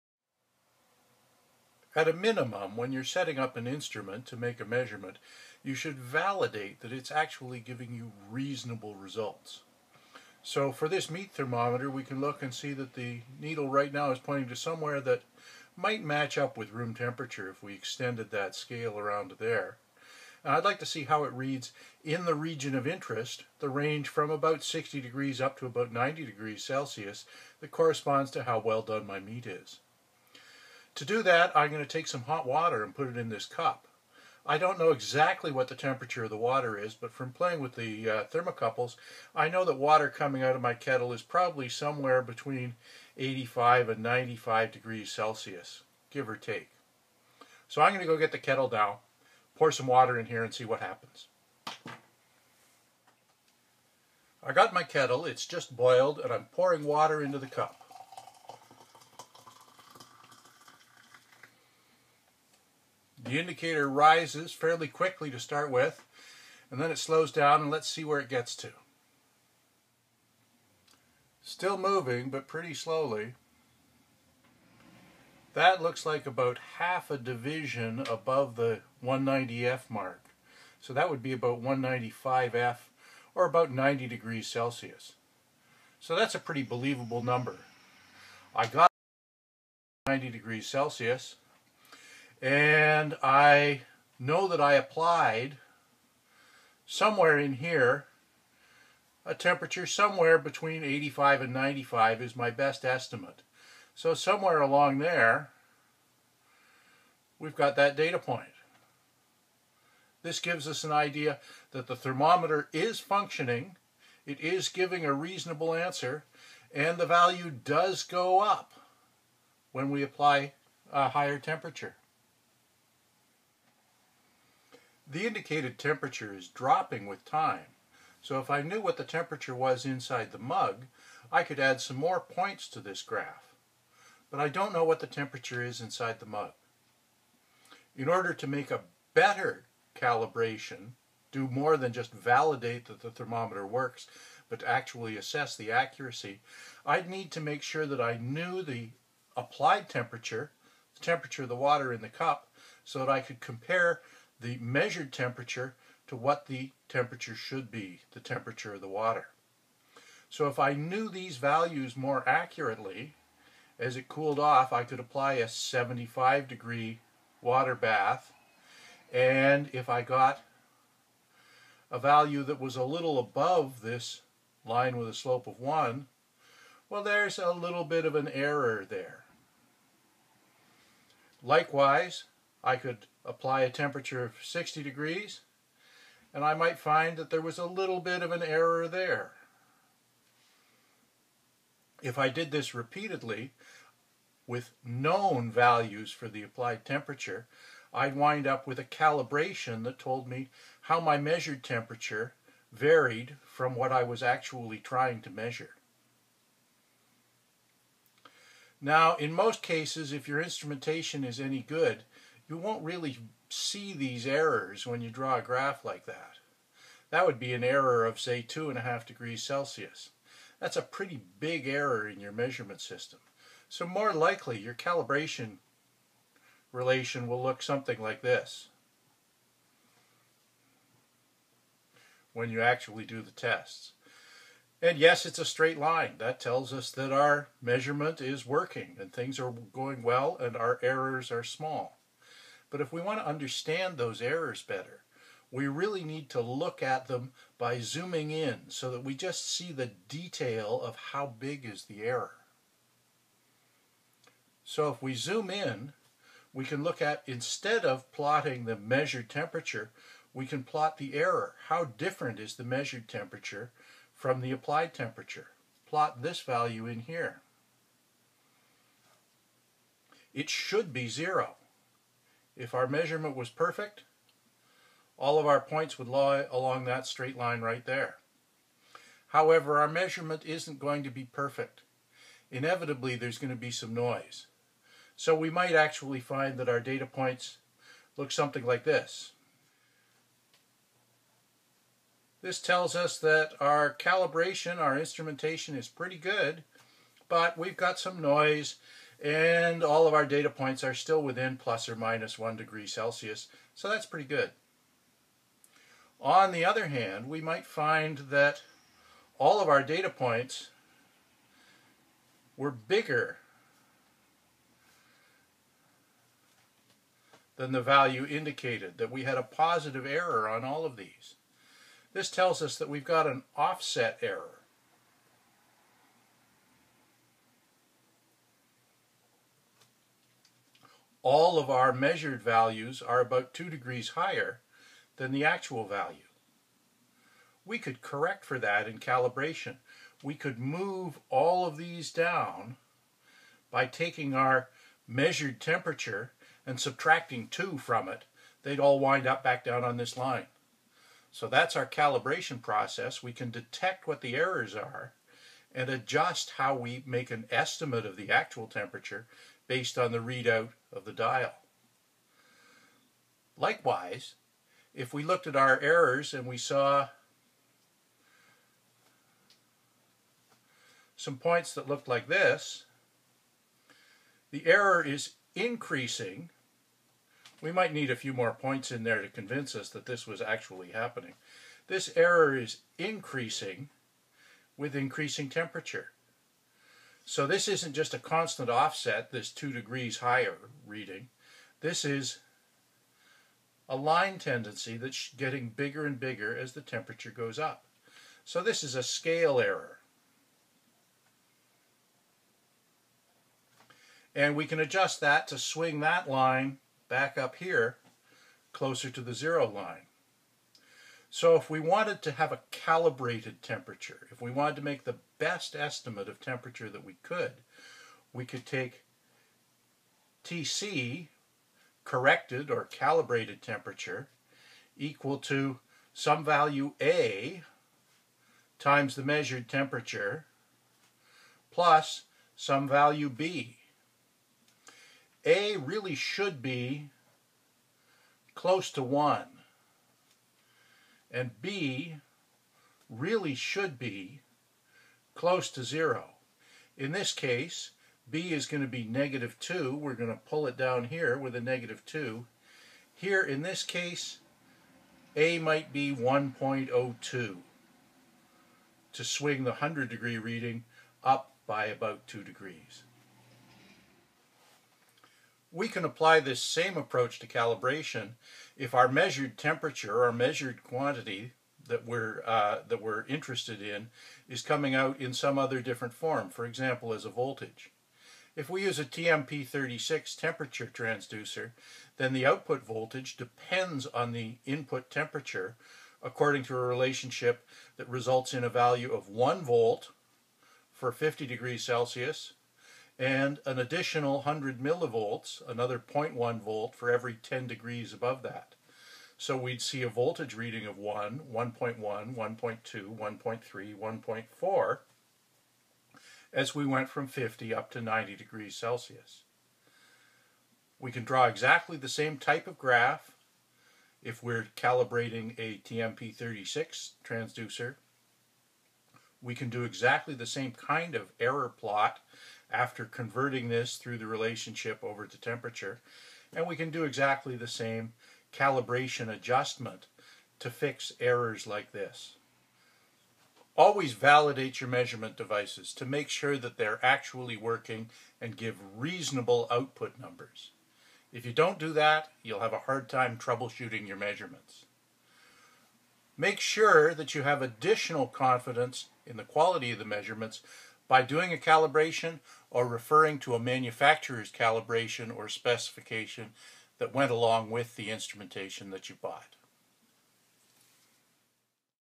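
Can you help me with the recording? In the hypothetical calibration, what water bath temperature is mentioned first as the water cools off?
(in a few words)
75 degrees.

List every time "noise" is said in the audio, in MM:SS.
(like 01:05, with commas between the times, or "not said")
04:43, 04:58.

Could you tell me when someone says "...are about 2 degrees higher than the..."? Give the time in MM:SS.
05:33.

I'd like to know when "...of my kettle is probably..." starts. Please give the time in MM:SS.
00:40.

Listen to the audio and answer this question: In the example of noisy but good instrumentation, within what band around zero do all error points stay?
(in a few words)
plus or minus 1 degree.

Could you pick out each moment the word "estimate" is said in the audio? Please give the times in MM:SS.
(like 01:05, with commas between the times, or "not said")
01:42, 05:57, 06:55.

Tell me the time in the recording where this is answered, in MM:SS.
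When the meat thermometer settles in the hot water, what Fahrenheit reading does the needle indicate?
01:21.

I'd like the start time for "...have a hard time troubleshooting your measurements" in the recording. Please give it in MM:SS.
09:02.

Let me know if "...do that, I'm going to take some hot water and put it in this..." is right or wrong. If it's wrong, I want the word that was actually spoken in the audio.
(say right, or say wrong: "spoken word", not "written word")
right.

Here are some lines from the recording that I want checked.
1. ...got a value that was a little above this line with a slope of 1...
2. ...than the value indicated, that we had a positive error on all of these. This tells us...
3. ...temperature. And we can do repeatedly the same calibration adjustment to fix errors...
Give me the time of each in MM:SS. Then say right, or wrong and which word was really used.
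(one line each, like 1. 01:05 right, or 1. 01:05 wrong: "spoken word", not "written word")
1. 02:50 right
2. 05:17 right
3. 08:45 wrong: "exactly", not "repeatedly".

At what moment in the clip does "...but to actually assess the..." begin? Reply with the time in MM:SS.
02:24.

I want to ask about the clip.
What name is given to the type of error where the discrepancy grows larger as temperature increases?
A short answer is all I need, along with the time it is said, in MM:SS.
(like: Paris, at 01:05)
scale error, at 06:39.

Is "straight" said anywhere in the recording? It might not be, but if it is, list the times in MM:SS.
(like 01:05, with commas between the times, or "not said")
03:55, 04:37.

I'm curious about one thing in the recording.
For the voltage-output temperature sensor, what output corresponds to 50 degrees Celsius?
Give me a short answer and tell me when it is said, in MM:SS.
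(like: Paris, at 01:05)
1 volt, at 08:09.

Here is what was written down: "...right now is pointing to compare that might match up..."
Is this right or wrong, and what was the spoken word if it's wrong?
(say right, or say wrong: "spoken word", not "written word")
wrong: "somewhere", not "compare".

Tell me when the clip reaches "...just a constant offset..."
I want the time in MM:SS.
06:27.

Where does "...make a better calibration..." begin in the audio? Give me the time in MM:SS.
02:18.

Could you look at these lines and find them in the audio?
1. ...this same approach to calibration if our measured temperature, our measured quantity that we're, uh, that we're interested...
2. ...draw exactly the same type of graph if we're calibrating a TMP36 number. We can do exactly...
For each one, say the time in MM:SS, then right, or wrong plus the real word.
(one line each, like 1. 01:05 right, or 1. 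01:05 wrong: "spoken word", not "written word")
1. 07:46 right
2. 08:31 wrong: "transducer", not "number".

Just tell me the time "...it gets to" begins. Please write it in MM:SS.
01:08.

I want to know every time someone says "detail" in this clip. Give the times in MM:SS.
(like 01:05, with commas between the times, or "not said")
04:10.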